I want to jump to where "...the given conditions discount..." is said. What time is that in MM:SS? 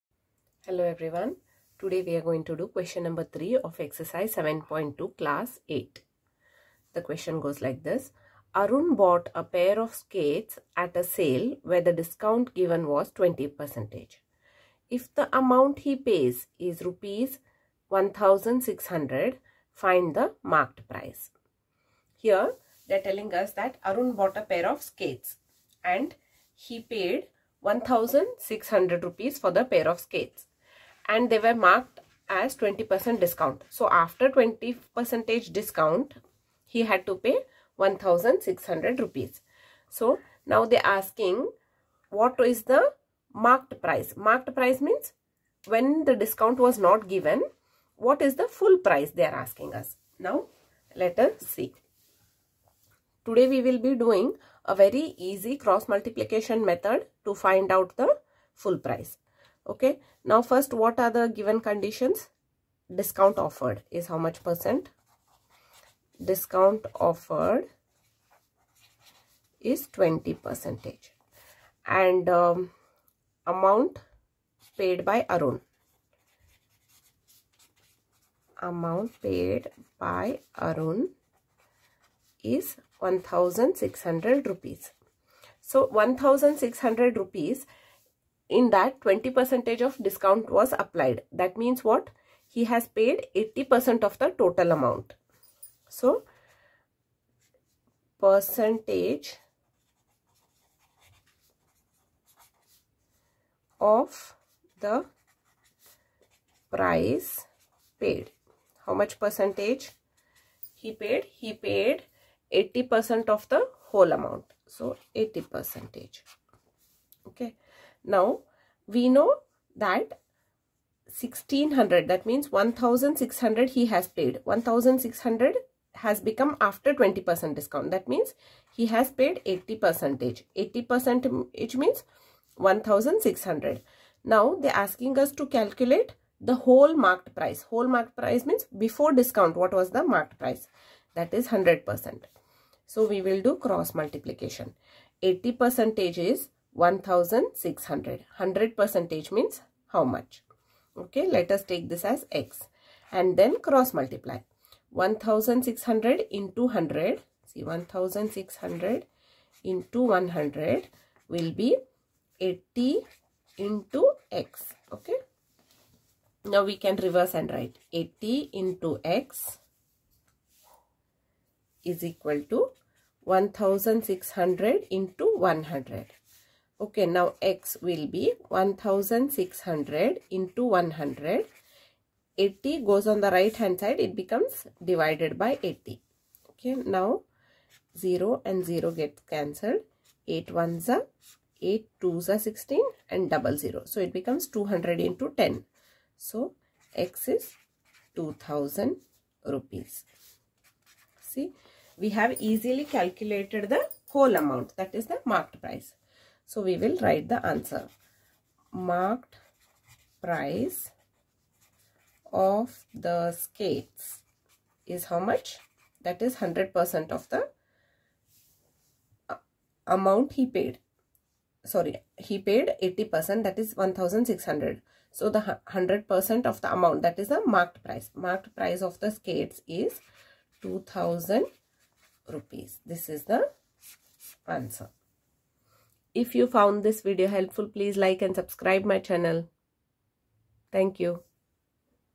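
01:01.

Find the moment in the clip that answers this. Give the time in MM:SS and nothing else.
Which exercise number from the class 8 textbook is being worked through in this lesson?
00:03.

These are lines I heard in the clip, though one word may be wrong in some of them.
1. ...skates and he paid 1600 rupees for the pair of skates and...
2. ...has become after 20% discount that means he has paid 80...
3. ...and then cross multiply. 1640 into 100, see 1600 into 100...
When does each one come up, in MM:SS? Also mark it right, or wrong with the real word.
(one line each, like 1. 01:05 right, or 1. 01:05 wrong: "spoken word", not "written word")
1. 00:24 right
2. 02:05 right
3. 02:33 wrong: "1600", not "1640".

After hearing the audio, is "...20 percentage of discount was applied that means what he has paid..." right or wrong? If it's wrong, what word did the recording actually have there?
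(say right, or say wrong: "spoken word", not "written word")
right.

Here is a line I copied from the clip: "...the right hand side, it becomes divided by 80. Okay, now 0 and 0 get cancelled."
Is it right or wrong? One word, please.
right.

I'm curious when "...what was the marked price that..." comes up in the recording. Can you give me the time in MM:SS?
02:19.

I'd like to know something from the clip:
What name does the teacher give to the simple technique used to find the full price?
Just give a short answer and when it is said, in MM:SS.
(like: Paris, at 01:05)
Cross multiplication method, at 00:55.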